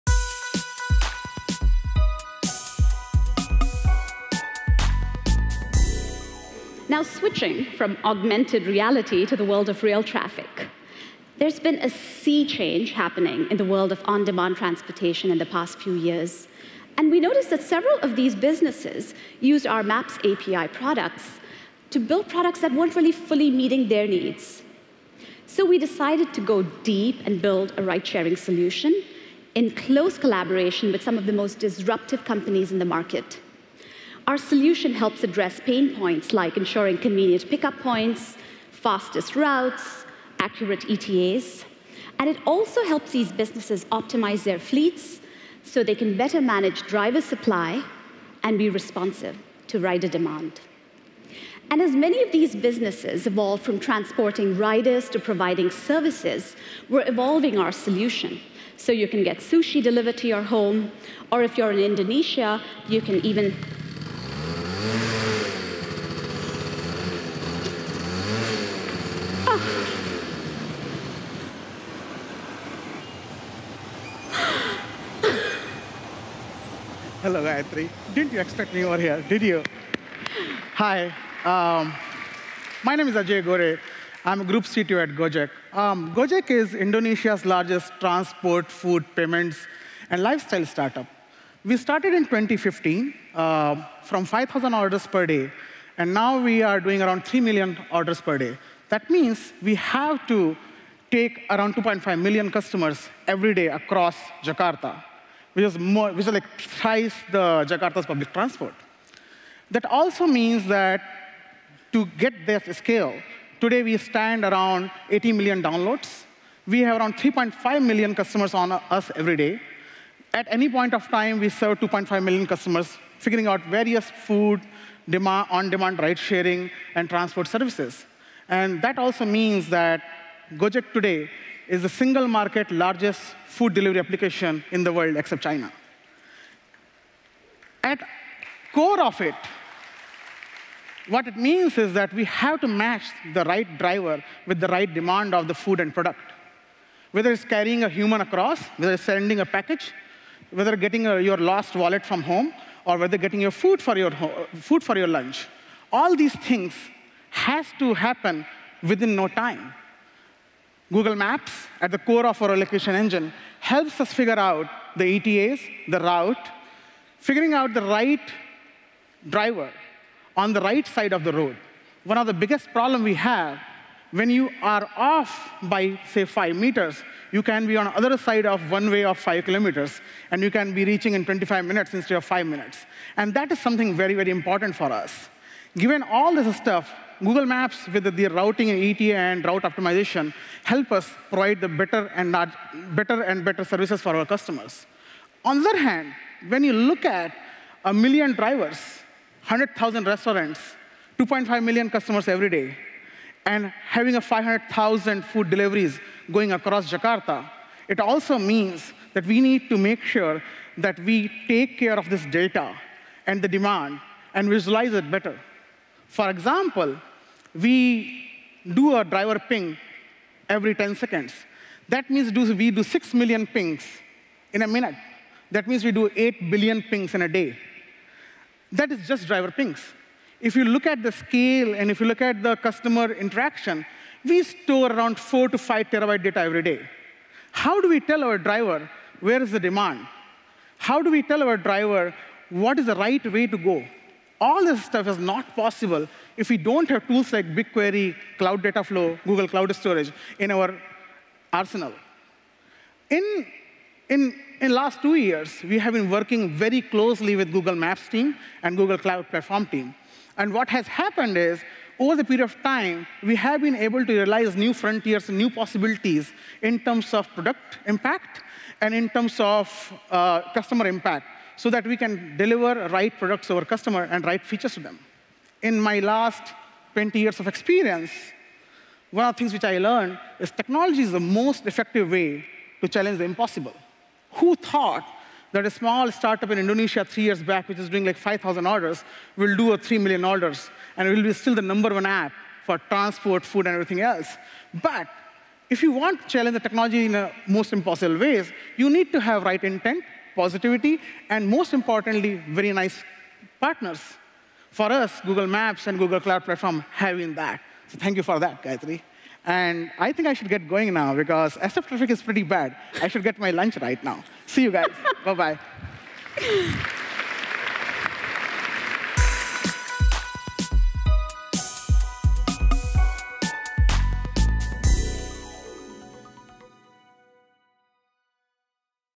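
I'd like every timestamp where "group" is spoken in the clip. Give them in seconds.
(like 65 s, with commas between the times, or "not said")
84 s.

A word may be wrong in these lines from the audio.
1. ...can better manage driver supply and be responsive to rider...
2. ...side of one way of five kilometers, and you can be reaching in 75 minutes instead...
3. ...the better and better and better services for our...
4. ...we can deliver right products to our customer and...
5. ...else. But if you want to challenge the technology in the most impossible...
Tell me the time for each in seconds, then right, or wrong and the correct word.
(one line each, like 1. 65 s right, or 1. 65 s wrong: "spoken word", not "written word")
1. 45 s right
2. 178 s wrong: "25", not "75"
3. 191 s right
4. 271 s right
5. 294 s right.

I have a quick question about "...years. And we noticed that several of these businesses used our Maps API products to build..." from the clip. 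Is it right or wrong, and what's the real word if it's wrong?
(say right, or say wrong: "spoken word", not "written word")
right.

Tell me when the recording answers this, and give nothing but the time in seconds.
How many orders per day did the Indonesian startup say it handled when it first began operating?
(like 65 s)
94 s.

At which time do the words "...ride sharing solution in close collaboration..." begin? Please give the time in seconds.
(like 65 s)
27 s.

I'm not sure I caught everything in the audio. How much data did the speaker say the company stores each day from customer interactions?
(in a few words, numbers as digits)
4 to 5 terabytes.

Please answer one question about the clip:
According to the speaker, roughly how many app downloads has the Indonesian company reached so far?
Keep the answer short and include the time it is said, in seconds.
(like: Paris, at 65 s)
80 million, at 115 s.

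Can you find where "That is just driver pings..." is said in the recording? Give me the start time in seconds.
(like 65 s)
228 s.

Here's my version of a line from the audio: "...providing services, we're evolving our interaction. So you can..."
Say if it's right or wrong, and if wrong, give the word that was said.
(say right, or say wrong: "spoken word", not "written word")
wrong: "solution", not "interaction".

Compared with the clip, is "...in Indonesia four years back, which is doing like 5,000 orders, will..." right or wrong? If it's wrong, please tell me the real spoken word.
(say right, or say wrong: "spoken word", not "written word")
wrong: "three", not "four".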